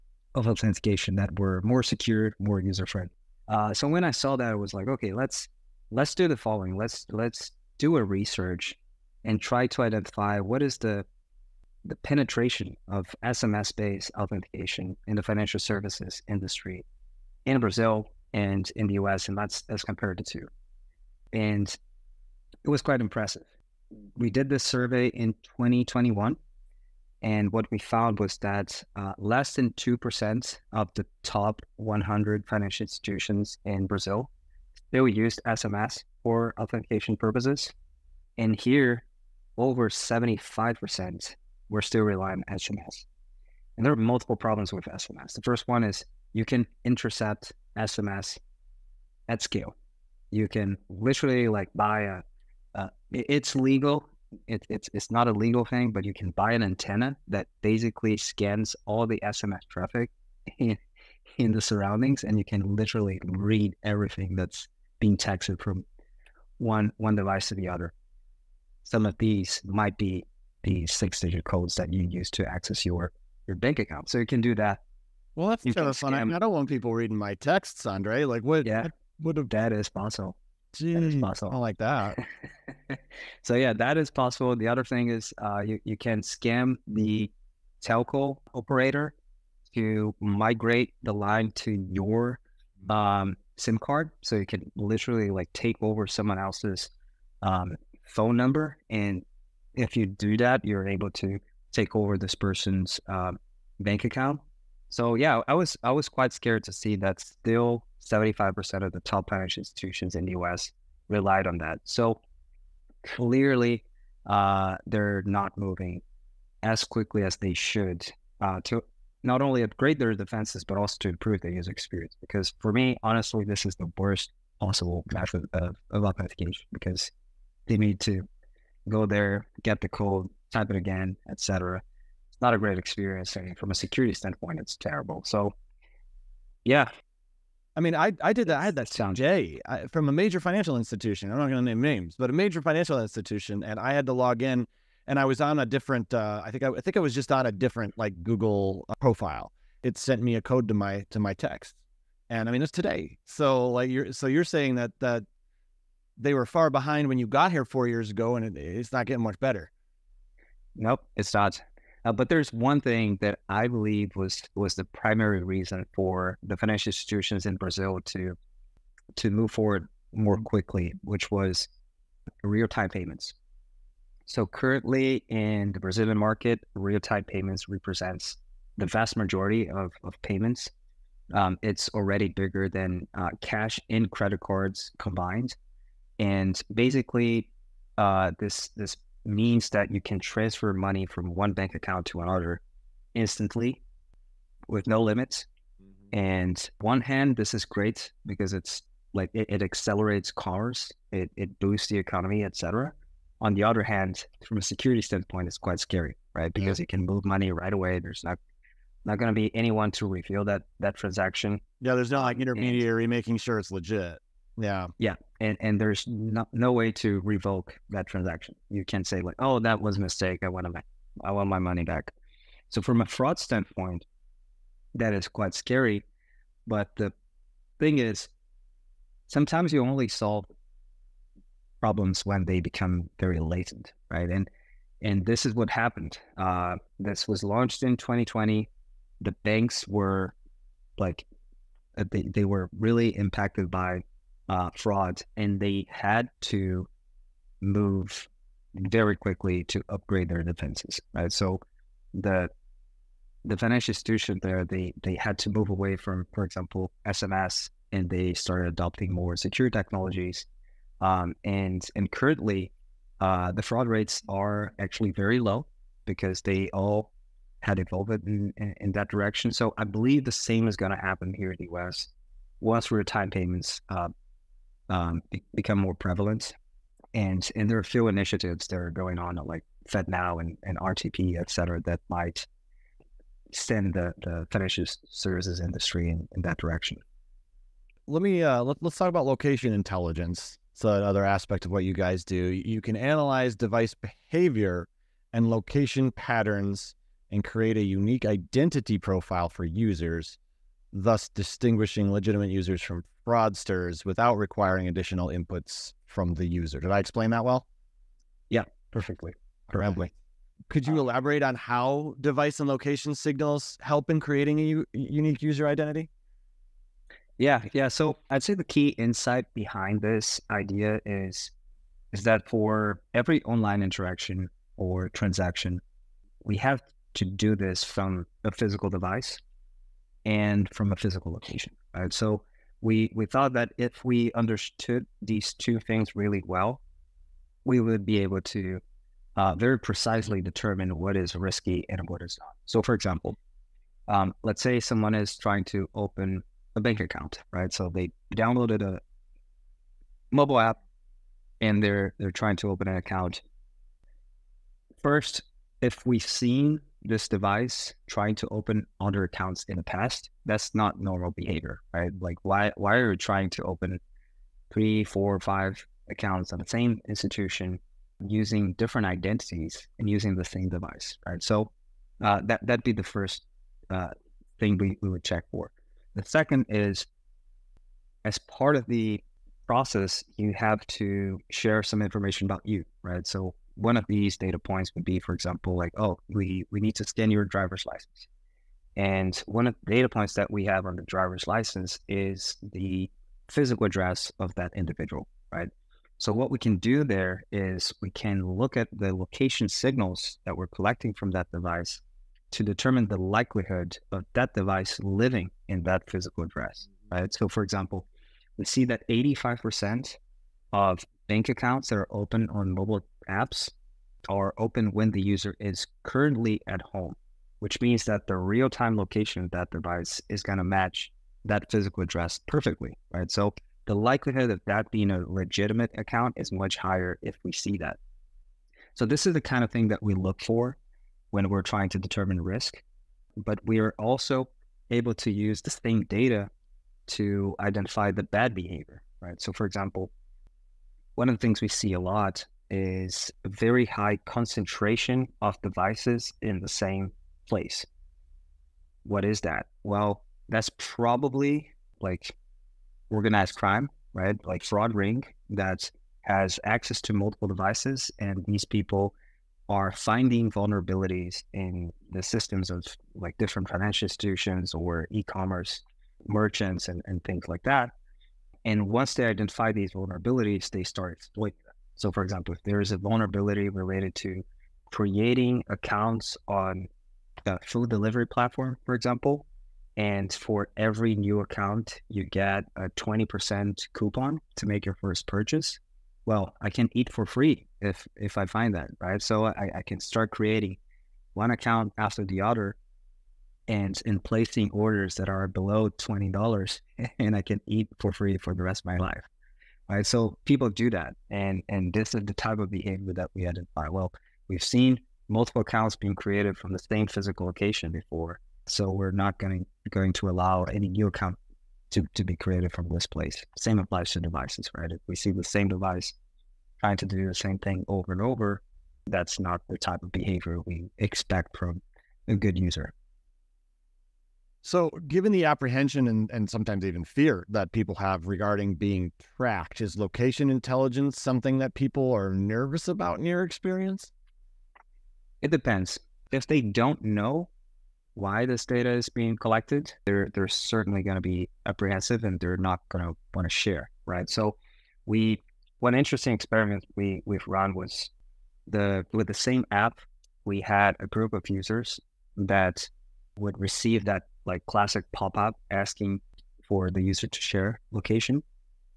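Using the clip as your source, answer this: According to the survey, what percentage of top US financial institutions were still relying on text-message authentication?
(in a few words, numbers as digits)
over 75%.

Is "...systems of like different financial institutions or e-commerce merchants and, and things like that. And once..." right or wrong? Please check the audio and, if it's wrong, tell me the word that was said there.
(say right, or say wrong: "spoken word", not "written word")
right.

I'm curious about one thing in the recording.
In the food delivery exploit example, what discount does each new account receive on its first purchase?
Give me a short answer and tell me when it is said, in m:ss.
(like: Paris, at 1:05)
20%, at 8:02.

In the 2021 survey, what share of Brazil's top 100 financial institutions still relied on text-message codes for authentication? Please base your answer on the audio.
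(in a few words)
less than 2%.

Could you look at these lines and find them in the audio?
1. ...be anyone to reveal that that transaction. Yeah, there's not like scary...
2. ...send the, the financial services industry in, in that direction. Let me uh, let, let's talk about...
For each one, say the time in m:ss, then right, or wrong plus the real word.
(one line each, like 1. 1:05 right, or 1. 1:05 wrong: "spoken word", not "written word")
1. 3:29 wrong: "intermediary", not "scary"
2. 4:43 right.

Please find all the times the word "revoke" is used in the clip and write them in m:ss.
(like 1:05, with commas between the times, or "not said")
3:37.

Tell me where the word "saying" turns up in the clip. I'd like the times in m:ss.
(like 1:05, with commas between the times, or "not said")
2:34.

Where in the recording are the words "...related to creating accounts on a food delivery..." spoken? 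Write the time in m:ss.
7:53.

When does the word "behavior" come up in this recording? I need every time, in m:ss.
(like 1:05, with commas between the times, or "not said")
4:53, 6:01, 7:18, 8:22, 8:40.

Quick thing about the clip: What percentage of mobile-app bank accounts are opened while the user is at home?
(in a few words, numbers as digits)
85%.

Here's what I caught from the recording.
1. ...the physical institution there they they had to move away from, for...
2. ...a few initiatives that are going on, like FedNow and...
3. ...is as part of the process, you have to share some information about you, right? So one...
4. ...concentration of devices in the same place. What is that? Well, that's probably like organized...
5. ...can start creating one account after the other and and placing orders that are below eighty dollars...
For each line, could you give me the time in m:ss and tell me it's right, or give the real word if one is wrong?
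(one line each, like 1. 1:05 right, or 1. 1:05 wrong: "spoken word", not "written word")
1. 4:13 wrong: "financial", not "physical"
2. 4:37 right
3. 6:16 right
4. 7:24 right
5. 8:09 wrong: "twenty", not "eighty".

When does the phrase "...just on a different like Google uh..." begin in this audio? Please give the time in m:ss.
2:27.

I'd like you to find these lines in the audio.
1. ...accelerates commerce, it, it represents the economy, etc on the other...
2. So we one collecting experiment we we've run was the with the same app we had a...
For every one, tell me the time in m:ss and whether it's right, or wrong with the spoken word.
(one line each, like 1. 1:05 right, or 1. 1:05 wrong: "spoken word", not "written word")
1. 3:19 wrong: "boosts", not "represents"
2. 9:04 wrong: "interesting", not "collecting".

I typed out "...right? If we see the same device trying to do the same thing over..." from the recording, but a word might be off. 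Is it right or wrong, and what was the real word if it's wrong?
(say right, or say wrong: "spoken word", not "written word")
right.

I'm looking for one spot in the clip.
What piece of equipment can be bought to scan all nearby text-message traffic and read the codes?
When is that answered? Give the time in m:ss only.
0:56.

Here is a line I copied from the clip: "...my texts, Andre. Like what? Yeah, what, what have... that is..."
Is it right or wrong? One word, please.
right.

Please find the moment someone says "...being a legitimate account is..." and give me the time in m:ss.
7:04.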